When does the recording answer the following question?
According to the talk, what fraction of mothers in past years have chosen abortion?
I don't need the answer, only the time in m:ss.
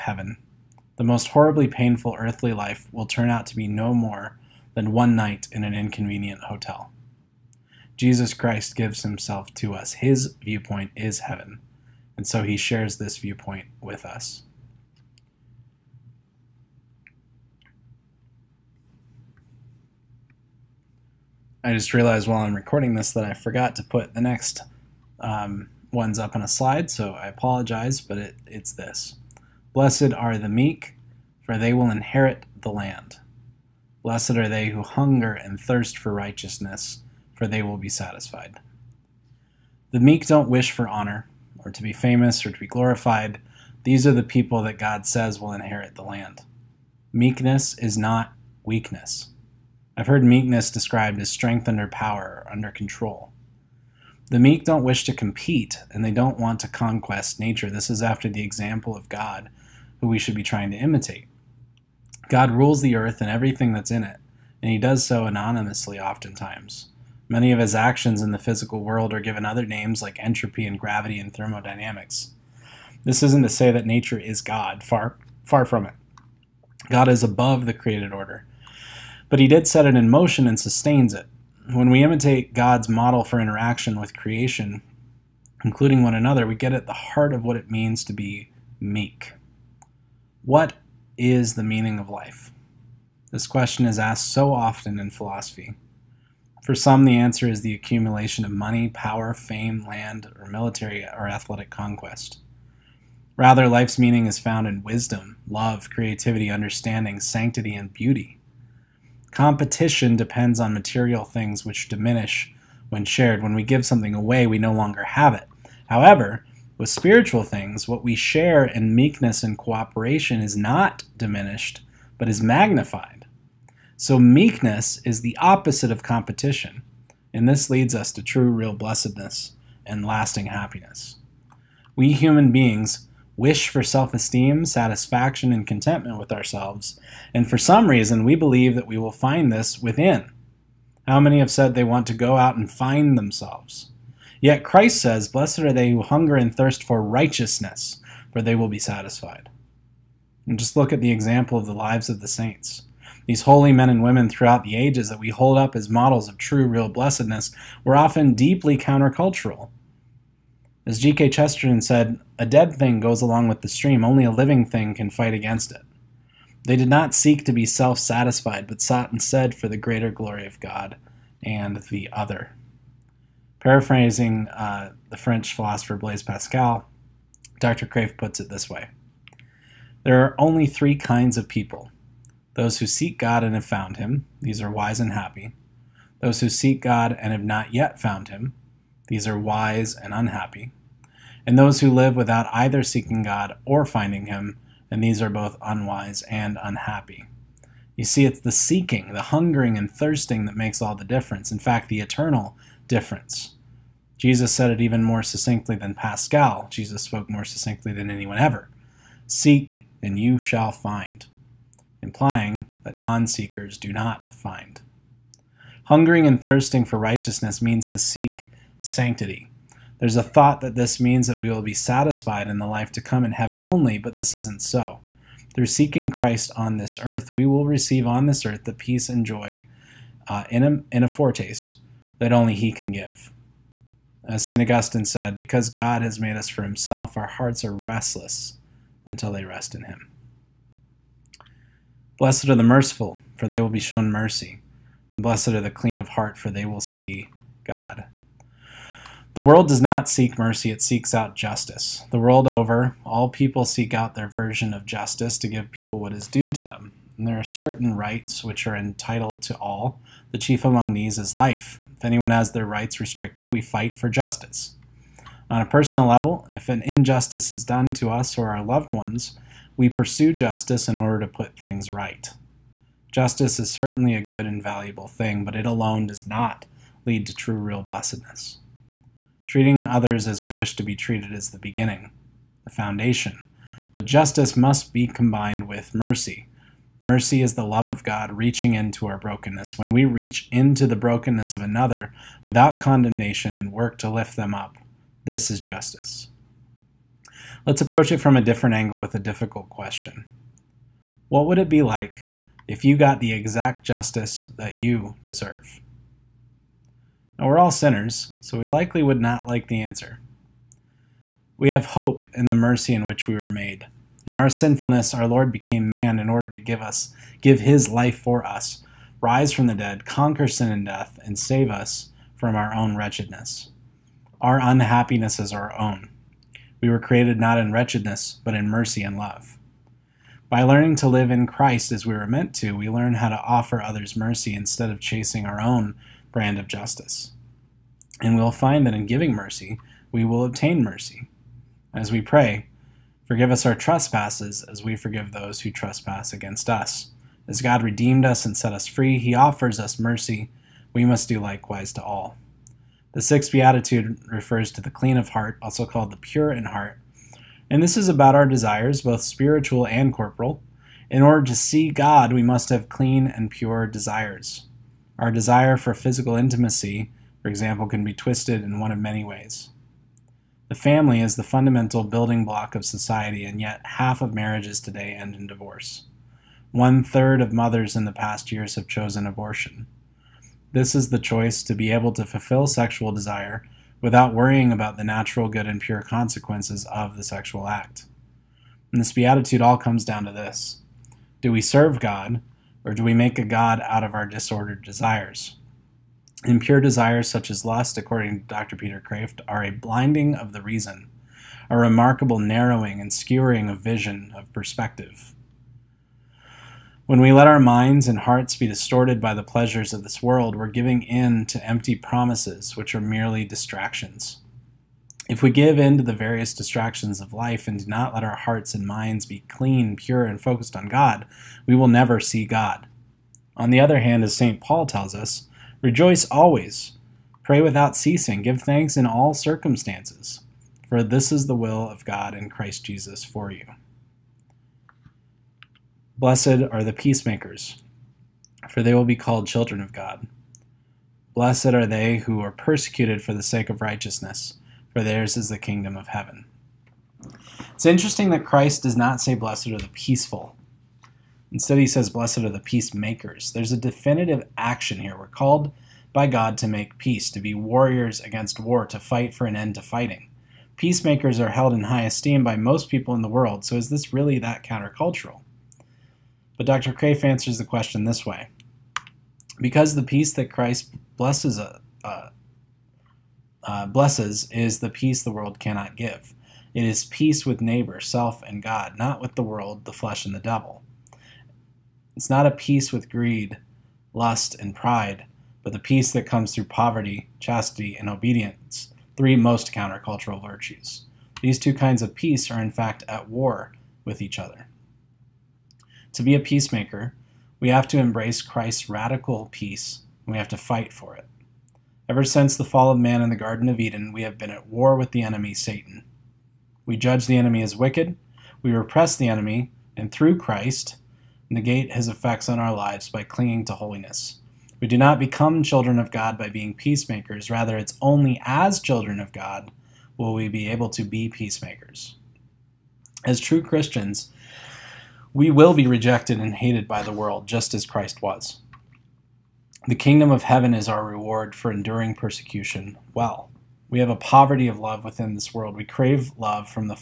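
6:16.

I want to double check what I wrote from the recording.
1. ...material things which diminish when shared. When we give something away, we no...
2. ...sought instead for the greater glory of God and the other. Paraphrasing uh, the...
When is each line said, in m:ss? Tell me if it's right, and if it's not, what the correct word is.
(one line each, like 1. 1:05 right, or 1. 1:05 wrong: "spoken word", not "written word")
1. 1:50 right
2. 2:48 right.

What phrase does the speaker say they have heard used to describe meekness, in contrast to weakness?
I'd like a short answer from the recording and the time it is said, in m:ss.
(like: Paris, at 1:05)
strength under power, at 0:51.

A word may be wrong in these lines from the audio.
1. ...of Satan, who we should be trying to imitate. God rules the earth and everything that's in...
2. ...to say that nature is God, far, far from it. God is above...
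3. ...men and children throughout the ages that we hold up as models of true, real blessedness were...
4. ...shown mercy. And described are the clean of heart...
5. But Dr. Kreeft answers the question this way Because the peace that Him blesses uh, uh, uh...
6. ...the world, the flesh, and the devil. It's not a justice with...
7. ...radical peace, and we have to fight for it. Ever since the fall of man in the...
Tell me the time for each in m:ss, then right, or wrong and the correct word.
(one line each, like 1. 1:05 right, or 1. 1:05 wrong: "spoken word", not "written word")
1. 0:58 wrong: "God", not "Satan"
2. 1:13 right
3. 2:33 wrong: "women", not "children"
4. 4:03 wrong: "blessed", not "described"
5. 7:46 wrong: "Christ", not "Him"
6. 7:59 wrong: "peace", not "justice"
7. 8:18 right.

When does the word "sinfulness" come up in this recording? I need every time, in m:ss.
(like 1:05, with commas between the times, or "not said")
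5:14.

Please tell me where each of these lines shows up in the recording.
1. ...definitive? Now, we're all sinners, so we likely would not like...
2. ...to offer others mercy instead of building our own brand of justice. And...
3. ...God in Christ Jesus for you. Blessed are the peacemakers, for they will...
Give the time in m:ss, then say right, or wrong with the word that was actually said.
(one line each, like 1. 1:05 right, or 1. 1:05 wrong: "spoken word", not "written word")
1. 5:05 wrong: "deserve", not "definitive"
2. 5:33 wrong: "chasing", not "building"
3. 7:12 right.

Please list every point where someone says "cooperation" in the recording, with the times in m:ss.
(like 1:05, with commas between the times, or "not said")
1:59.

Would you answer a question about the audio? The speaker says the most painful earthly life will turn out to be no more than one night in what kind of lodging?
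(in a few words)
an inconvenient hotel.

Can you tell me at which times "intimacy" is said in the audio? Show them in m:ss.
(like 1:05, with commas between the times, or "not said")
6:06.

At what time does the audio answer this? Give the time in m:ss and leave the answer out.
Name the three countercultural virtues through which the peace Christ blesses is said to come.
8:06.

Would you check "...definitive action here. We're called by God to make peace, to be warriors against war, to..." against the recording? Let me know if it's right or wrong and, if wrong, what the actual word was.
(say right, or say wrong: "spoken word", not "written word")
right.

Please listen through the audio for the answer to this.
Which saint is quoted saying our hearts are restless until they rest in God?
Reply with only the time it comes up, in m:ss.
3:54.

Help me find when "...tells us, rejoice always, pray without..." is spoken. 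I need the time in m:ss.
7:04.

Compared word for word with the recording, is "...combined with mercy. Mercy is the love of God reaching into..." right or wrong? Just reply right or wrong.
right.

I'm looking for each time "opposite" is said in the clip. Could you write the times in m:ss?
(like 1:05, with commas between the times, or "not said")
2:05.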